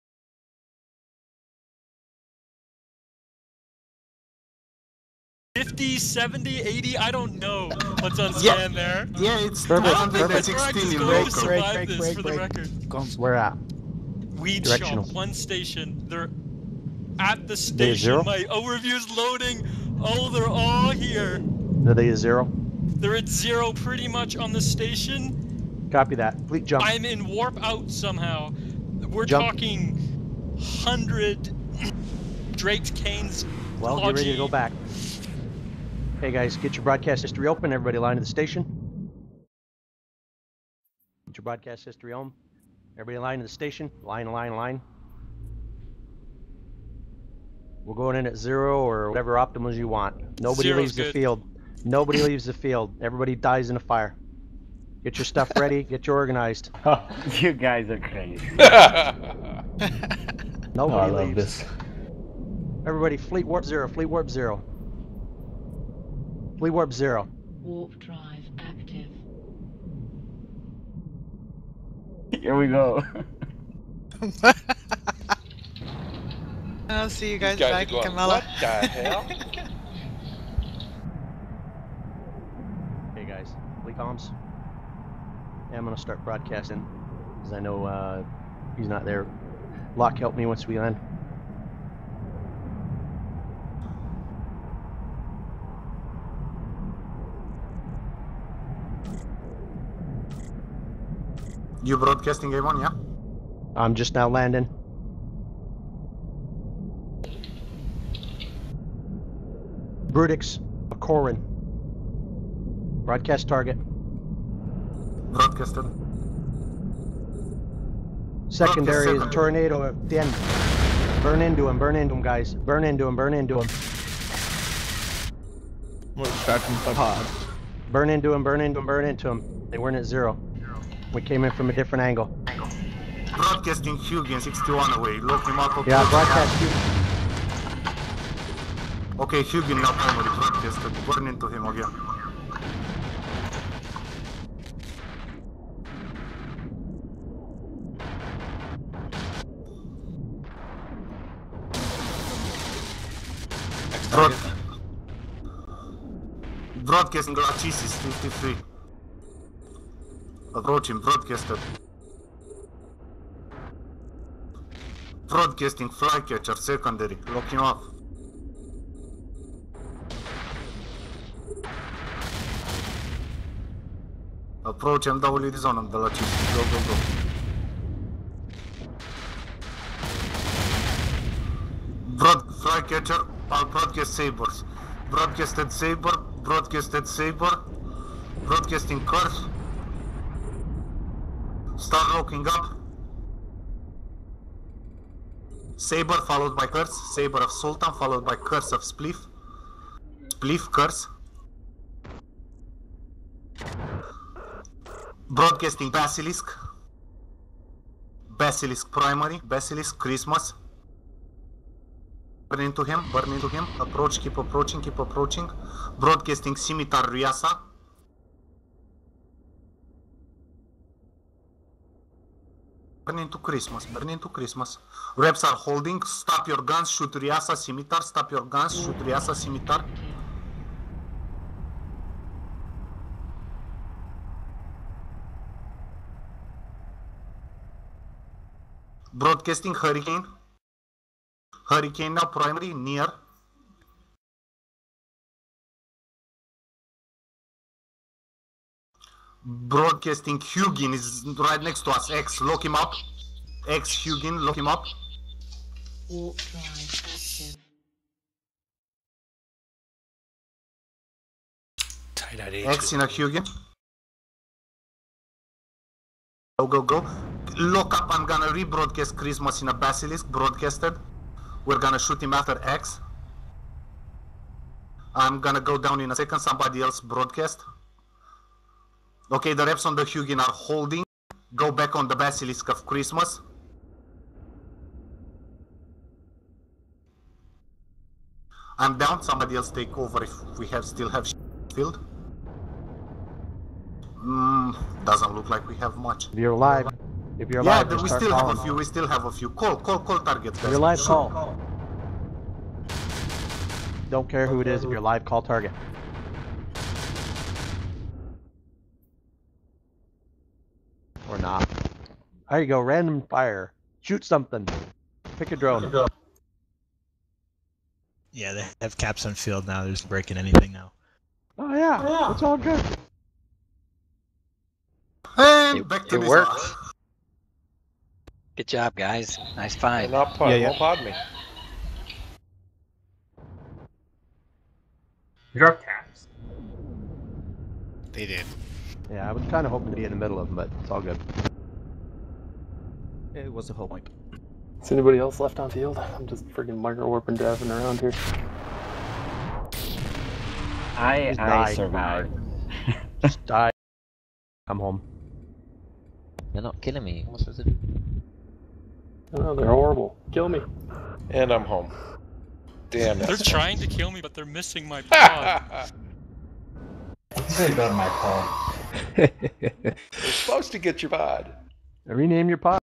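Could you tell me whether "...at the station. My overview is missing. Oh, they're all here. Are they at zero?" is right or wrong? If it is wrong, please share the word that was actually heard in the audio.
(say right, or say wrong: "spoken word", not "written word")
wrong: "loading", not "missing".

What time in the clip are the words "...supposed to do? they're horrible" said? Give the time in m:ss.
5:57.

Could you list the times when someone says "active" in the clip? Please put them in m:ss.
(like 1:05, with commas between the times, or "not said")
1:08, 4:16.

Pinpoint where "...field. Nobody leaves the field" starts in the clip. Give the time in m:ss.
0:51.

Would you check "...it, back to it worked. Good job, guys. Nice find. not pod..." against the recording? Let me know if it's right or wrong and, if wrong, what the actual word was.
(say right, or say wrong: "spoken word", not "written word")
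right.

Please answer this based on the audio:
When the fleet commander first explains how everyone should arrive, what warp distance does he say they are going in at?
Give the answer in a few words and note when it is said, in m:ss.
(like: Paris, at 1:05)
0, at 0:47.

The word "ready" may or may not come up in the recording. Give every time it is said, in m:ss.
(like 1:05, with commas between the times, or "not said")
0:34, 0:55.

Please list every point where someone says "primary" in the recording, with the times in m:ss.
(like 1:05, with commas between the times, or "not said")
2:19, 3:28, 4:02.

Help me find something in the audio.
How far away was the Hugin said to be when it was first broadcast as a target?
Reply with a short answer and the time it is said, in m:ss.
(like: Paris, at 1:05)
61, at 2:13.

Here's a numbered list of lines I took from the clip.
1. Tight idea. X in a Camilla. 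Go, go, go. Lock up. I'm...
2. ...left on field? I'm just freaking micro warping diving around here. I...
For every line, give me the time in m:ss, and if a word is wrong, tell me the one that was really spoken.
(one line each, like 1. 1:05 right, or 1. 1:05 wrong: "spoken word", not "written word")
1. 4:22 wrong: "Hugin", not "Camilla"
2. 5:45 right.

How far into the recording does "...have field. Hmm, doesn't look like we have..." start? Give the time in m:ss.
4:51.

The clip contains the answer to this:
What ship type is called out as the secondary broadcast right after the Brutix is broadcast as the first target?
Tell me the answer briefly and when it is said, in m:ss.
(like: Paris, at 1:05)
Tornado, at 1:58.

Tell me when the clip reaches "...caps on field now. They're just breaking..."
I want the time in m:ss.
5:18.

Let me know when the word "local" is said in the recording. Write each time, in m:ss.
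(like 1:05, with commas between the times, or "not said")
0:10.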